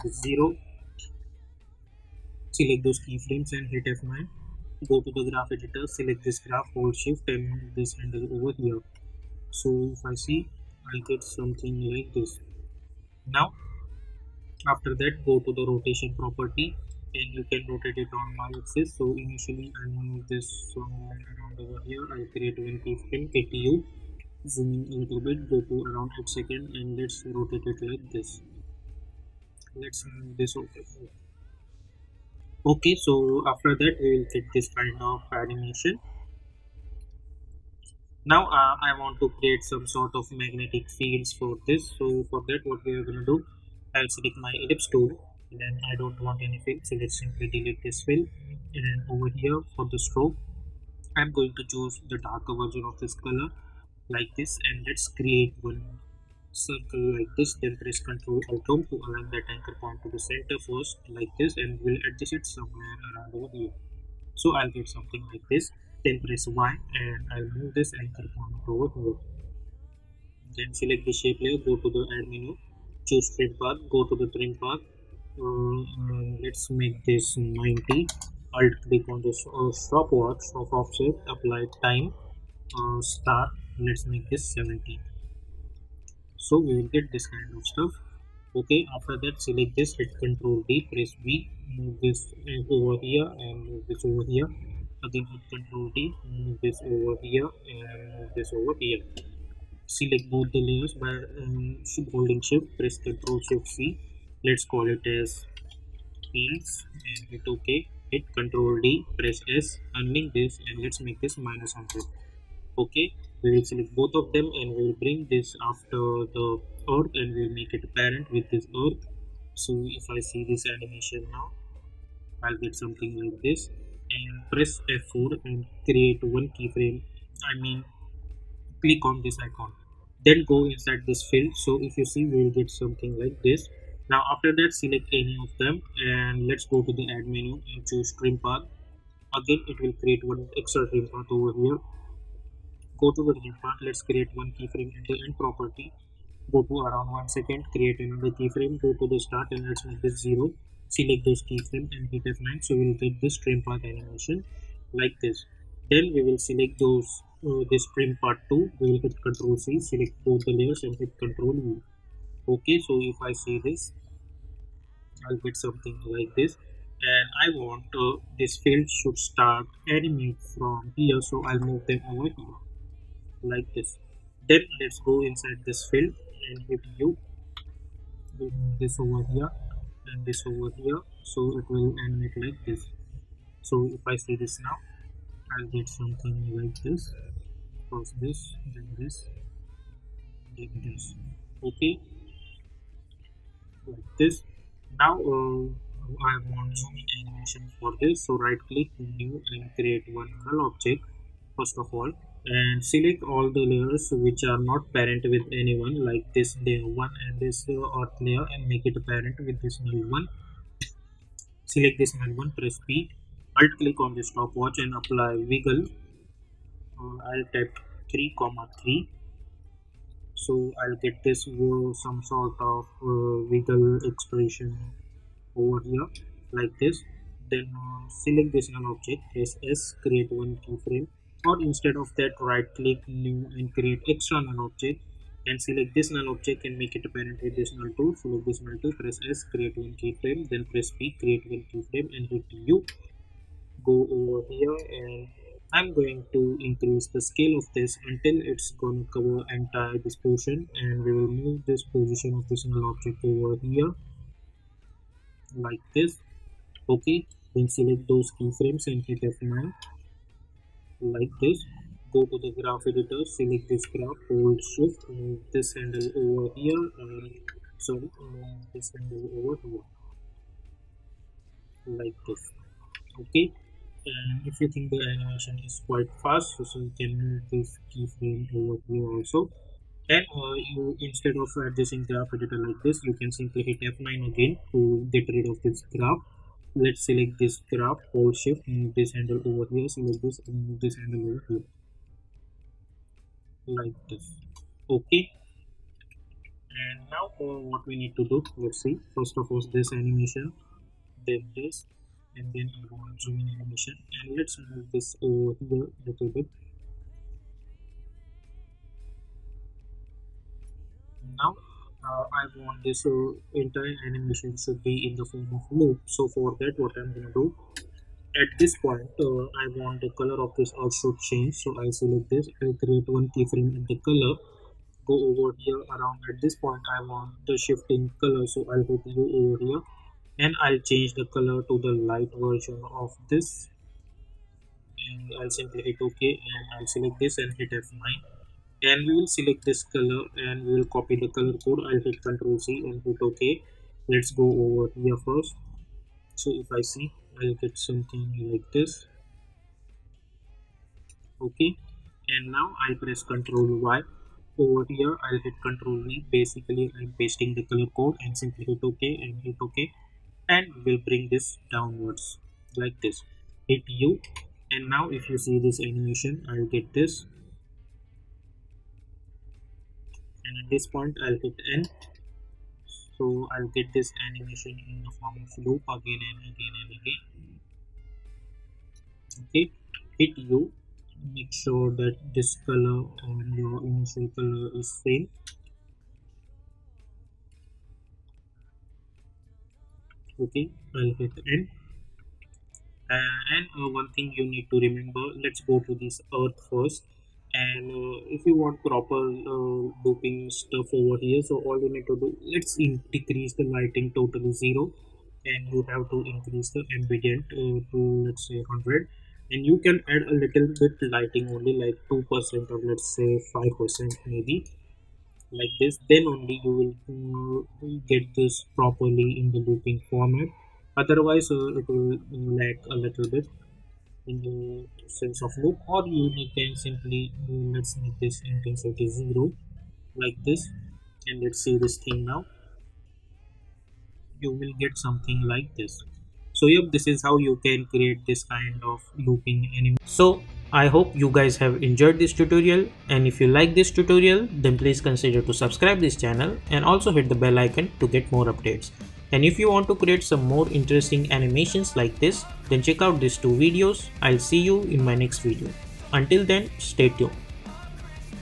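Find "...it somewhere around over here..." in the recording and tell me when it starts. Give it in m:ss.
1:02.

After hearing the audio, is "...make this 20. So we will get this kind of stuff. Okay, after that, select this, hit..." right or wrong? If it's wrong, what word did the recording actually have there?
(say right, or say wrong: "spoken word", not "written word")
wrong: "70", not "20".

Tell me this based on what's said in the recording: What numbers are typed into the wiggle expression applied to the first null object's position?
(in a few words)
3,3.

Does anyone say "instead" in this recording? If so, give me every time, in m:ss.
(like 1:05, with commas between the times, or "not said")
3:51, 4:40.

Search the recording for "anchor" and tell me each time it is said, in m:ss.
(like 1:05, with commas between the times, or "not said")
0:59, 1:08.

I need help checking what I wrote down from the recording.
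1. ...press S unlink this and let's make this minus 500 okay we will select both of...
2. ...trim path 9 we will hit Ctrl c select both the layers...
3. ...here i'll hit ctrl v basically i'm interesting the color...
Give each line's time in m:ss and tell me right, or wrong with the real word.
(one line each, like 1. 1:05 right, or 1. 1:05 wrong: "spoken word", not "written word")
1. 1:49 wrong: "100", not "500"
2. 2:37 wrong: "2", not "9"
3. 5:54 wrong: "pasting", not "interesting".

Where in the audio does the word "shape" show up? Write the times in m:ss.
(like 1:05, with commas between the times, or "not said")
1:11.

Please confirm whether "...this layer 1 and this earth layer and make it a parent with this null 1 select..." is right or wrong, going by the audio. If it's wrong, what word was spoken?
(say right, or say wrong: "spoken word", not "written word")
right.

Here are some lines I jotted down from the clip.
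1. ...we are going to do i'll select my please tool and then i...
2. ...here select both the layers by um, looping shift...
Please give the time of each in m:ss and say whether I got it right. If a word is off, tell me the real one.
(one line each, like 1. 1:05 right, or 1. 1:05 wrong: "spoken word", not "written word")
1. 0:42 wrong: "ellipse", not "please"
2. 1:38 wrong: "holding", not "looping".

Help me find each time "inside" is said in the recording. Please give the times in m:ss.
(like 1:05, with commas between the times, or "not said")
2:10, 2:55.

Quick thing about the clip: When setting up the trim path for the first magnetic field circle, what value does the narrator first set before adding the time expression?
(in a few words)
90.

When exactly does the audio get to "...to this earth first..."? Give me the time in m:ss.
6:35.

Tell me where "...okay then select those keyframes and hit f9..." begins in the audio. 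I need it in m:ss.
4:16.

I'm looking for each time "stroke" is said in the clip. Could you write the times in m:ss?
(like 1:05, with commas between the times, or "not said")
0:50.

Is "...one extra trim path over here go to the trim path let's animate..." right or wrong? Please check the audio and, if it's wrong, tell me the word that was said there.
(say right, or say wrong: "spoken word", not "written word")
wrong: "create", not "animate".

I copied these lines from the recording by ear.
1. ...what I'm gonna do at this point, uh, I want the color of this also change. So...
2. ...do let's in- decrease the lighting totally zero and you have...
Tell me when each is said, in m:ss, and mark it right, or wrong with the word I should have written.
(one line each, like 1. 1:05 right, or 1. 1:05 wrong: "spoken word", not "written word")
1. 5:16 right
2. 6:42 right.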